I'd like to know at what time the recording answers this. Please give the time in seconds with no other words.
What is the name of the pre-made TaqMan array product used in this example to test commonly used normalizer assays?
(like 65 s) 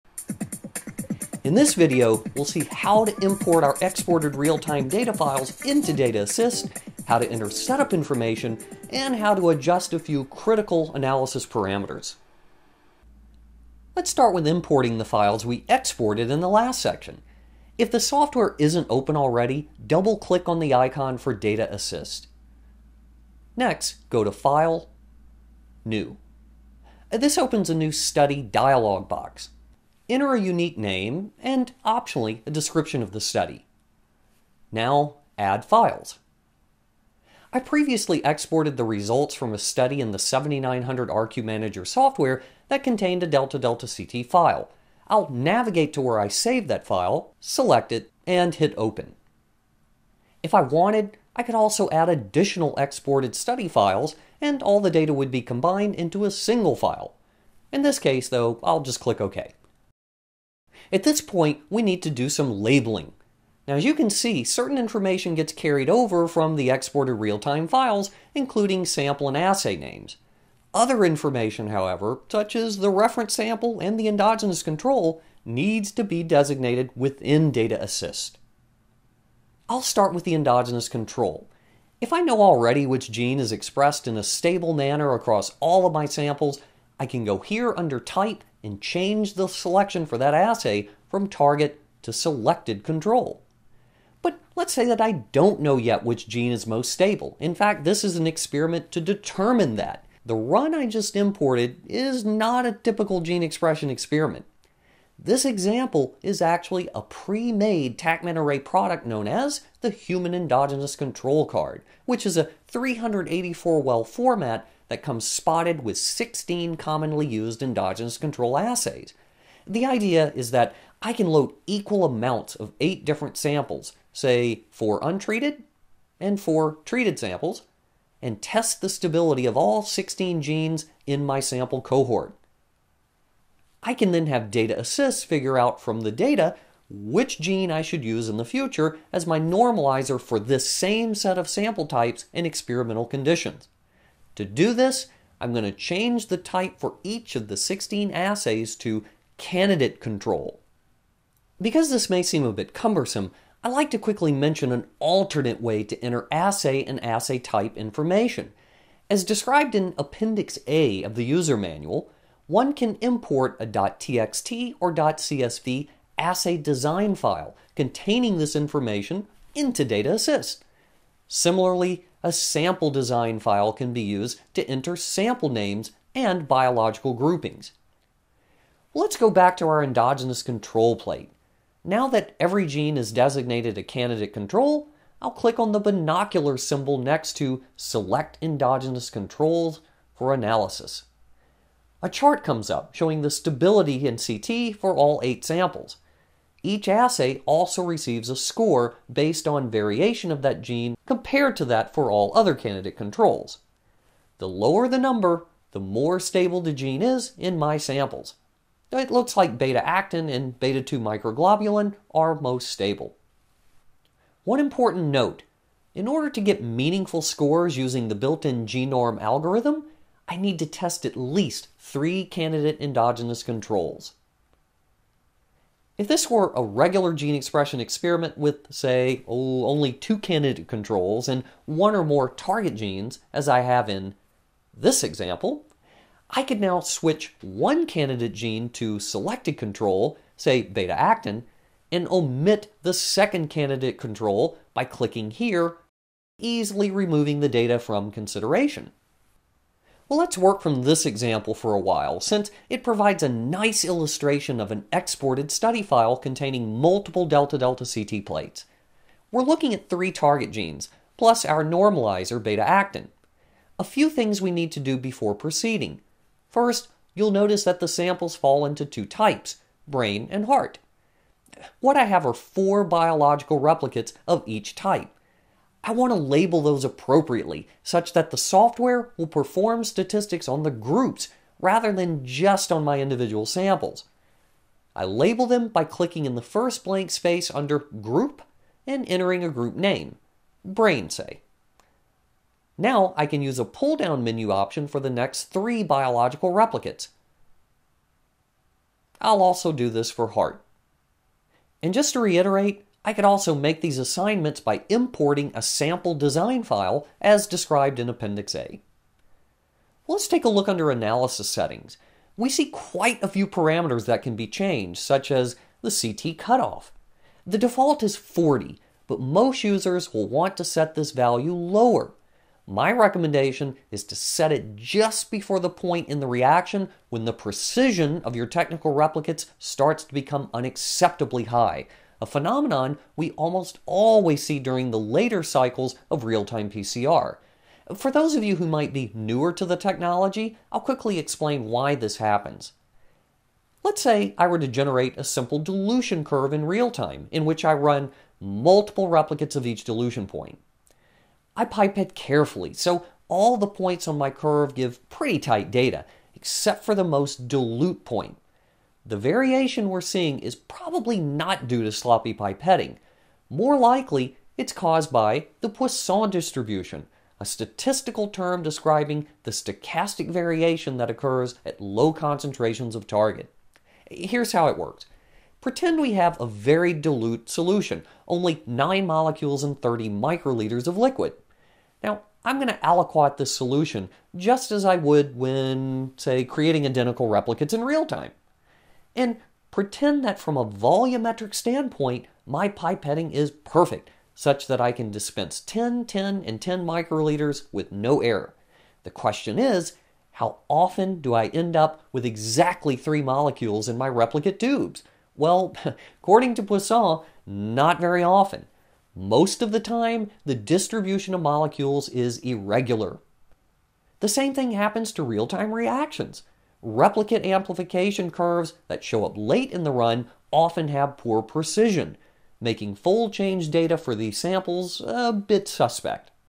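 109 s.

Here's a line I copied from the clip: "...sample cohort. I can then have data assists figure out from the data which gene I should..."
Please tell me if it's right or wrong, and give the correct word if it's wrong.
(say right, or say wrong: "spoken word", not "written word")
right.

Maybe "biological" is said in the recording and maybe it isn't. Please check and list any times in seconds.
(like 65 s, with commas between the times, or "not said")
176 s, 272 s, 295 s.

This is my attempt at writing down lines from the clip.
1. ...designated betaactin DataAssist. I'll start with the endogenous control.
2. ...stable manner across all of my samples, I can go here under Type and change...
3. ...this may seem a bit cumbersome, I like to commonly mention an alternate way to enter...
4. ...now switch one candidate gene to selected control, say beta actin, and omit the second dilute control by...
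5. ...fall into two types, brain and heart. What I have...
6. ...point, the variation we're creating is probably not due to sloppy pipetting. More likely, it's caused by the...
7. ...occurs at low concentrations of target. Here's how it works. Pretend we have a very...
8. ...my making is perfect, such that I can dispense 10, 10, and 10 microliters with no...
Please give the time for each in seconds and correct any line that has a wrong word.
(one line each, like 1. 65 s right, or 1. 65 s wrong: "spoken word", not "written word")
1. 76 s wrong: "within", not "betaactin"
2. 84 s right
3. 151 s wrong: "quickly", not "commonly"
4. 236 s wrong: "candidate", not "dilute"
5. 268 s right
6. 358 s wrong: "seeing", not "creating"
7. 371 s right
8. 392 s wrong: "pipetting", not "making".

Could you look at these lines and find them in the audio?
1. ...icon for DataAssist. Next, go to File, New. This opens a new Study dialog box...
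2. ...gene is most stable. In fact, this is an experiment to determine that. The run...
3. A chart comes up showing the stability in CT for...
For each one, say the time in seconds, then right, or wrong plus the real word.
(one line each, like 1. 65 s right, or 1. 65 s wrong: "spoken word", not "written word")
1. 20 s right
2. 96 s right
3. 192 s right.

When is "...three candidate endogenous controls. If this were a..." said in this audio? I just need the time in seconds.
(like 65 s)
221 s.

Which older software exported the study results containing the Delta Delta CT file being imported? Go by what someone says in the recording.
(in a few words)
7900 RQ Manager.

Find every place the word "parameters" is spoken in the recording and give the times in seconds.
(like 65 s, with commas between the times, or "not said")
11 s, 313 s.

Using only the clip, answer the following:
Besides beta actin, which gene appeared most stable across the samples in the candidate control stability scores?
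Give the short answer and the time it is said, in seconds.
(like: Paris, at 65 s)
beta 2 microglobulin, at 210 s.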